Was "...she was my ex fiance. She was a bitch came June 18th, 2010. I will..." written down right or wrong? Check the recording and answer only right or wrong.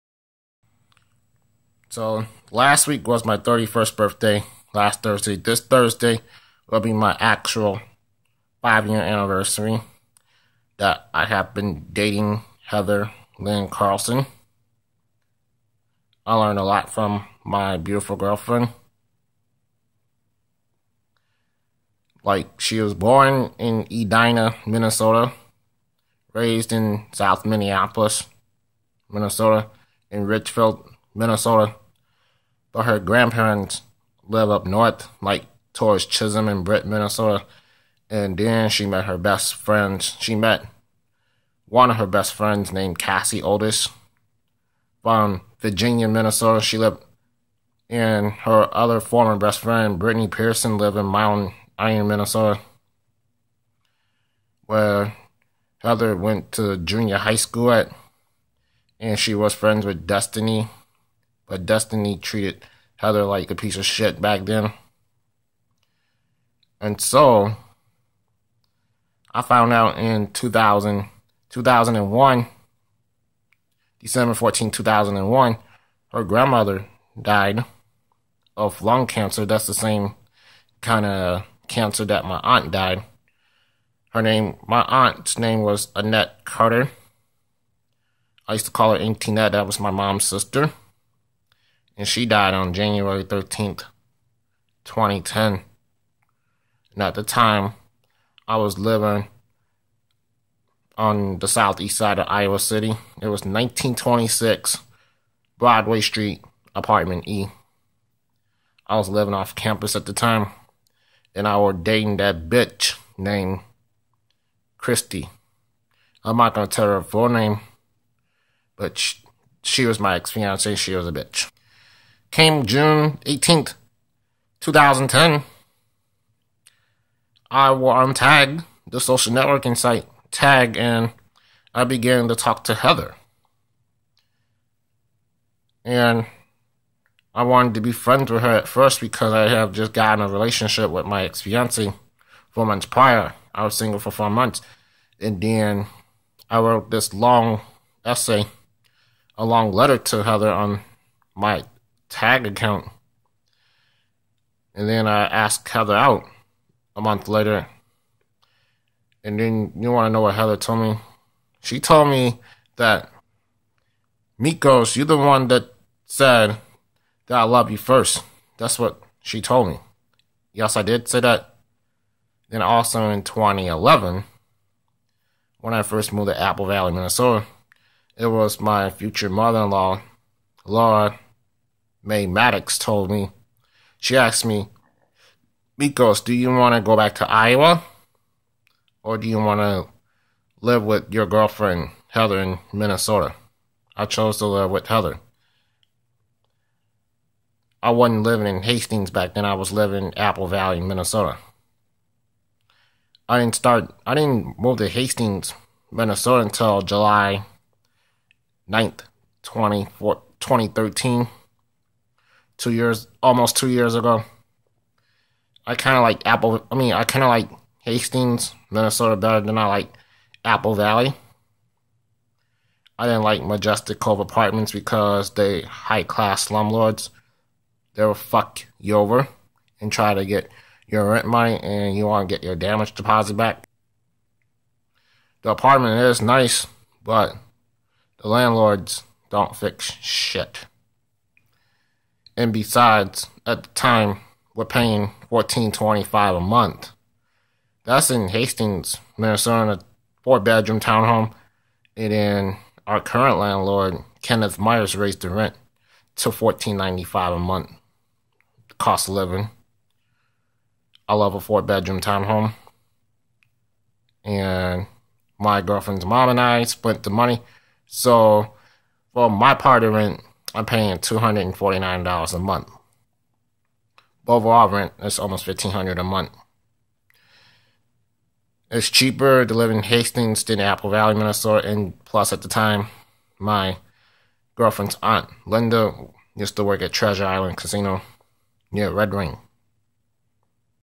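right.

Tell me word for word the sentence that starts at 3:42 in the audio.
I didn't like Majestic Cove Apartments because they high class slumlords.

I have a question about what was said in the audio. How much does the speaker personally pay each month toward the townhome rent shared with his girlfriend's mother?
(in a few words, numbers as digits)
$249.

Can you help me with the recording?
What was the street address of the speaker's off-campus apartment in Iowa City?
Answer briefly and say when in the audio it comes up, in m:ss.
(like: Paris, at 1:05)
1926 Broadway Street, at 1:43.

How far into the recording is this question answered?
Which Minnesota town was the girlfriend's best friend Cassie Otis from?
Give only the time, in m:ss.
0:45.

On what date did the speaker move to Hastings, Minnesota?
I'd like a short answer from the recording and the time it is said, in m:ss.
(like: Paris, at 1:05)
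July 9th, 2013, at 3:26.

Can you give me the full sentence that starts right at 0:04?
Last Thursday, this Thursday will be my actual five year anniversary that I have been dating Heather Lynn Carlson.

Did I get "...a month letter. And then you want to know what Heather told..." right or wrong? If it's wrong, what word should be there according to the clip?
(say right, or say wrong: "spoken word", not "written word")
wrong: "later", not "letter".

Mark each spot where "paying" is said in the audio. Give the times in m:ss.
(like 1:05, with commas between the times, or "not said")
4:04, 4:30.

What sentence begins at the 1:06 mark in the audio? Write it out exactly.
And so I found out in 2000, 2001, December 14, 2001, her grandmother died of lung cancer.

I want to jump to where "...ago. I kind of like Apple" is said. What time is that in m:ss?
3:33.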